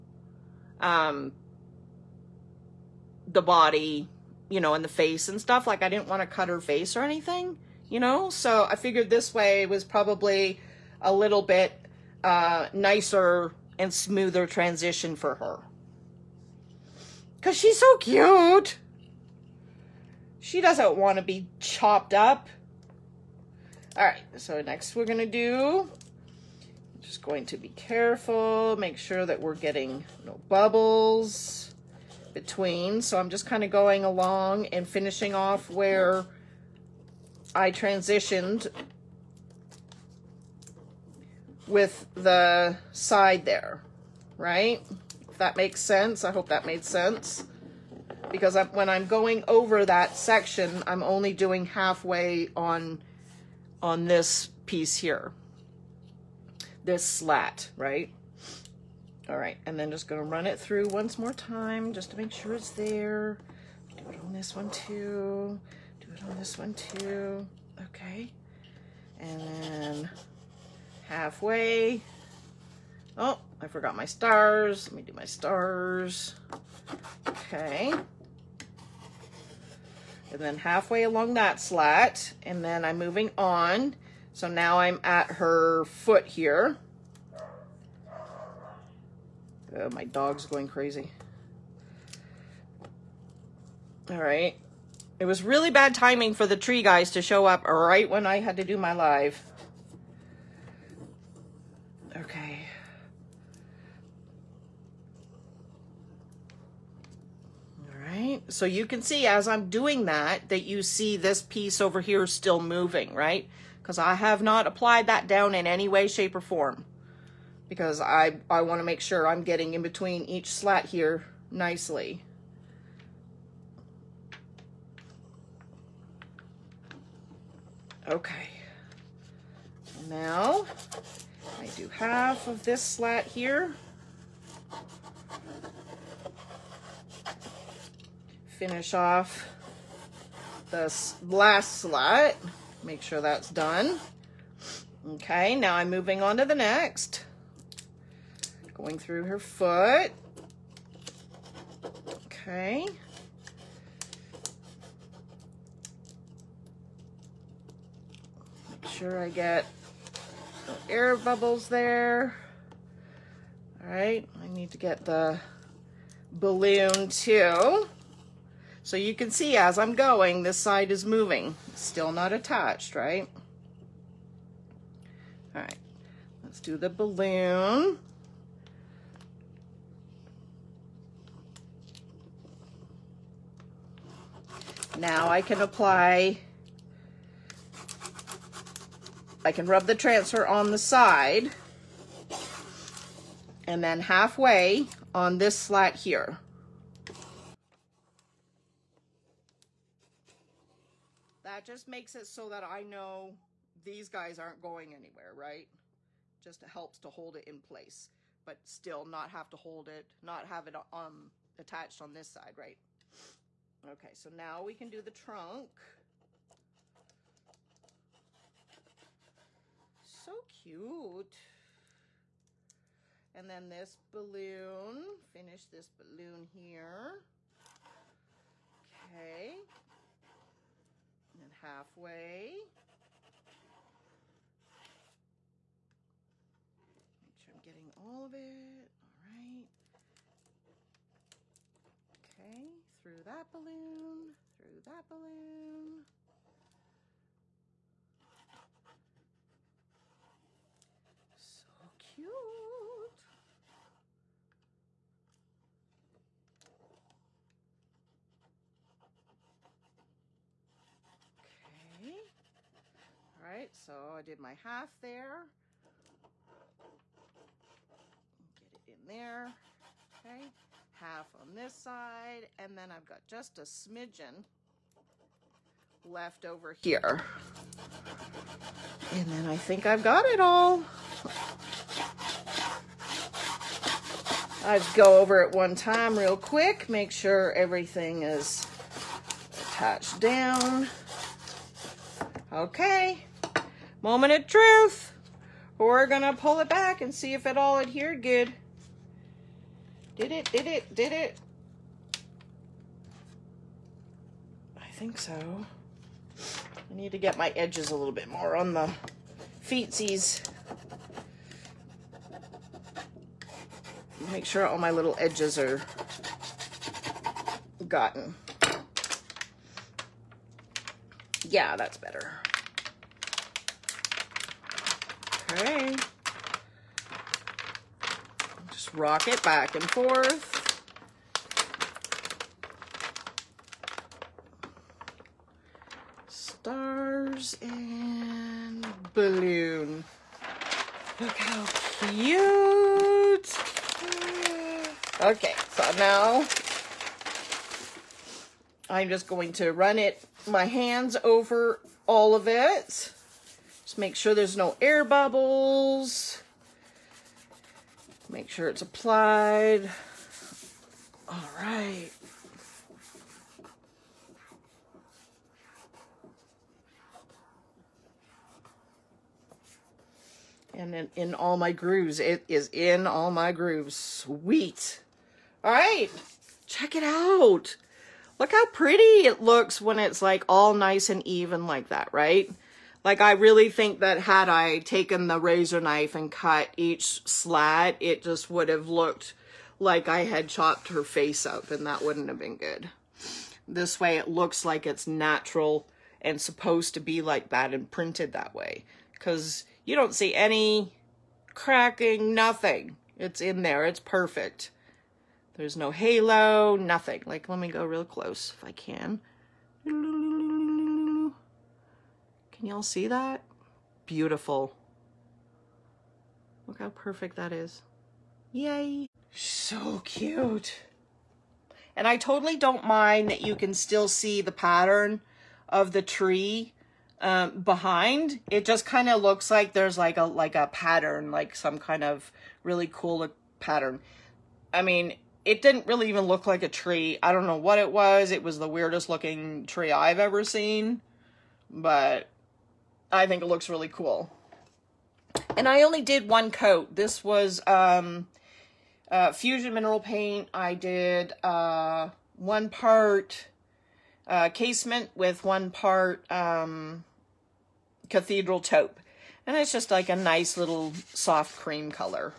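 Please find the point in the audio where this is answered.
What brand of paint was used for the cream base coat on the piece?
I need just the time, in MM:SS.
07:29.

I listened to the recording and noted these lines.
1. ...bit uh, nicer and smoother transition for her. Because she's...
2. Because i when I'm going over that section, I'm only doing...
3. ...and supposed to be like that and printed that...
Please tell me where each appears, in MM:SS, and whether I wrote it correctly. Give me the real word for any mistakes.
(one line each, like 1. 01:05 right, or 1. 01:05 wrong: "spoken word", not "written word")
1. 00:11 right
2. 00:48 right
3. 06:36 right.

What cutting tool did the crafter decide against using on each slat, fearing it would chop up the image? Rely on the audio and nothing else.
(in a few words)
Razor knife.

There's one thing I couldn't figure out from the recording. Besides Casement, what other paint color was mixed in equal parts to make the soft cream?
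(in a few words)
Cathedral Taupe.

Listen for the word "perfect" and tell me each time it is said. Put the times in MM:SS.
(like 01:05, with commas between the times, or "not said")
06:44, 06:56.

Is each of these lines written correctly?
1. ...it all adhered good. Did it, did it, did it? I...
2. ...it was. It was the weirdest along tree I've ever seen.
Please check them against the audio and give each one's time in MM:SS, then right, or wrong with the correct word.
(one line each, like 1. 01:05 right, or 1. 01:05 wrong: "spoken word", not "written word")
1. 04:57 right
2. 07:17 wrong: "looking", not "along".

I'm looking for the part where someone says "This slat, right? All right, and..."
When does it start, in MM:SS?
00:56.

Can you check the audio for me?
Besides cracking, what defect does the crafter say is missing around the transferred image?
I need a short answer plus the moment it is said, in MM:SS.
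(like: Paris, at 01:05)
Halo, at 06:45.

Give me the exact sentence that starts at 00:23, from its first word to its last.
All right, so next we're going to do, just going to be careful, make sure that we're getting no bubbles between.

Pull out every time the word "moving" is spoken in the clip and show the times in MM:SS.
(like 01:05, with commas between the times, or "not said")
01:22, 01:52, 02:25, 02:51.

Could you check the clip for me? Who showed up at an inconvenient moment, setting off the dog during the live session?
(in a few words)
The tree guys.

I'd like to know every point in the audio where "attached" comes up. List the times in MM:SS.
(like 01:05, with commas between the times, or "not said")
02:52, 03:31, 04:49.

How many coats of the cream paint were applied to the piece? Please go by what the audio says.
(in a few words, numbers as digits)
1.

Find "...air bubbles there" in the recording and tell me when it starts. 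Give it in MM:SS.
02:40.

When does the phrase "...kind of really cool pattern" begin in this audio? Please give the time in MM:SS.
07:11.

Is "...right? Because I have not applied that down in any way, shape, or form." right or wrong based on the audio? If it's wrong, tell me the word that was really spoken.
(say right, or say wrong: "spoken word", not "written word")
right.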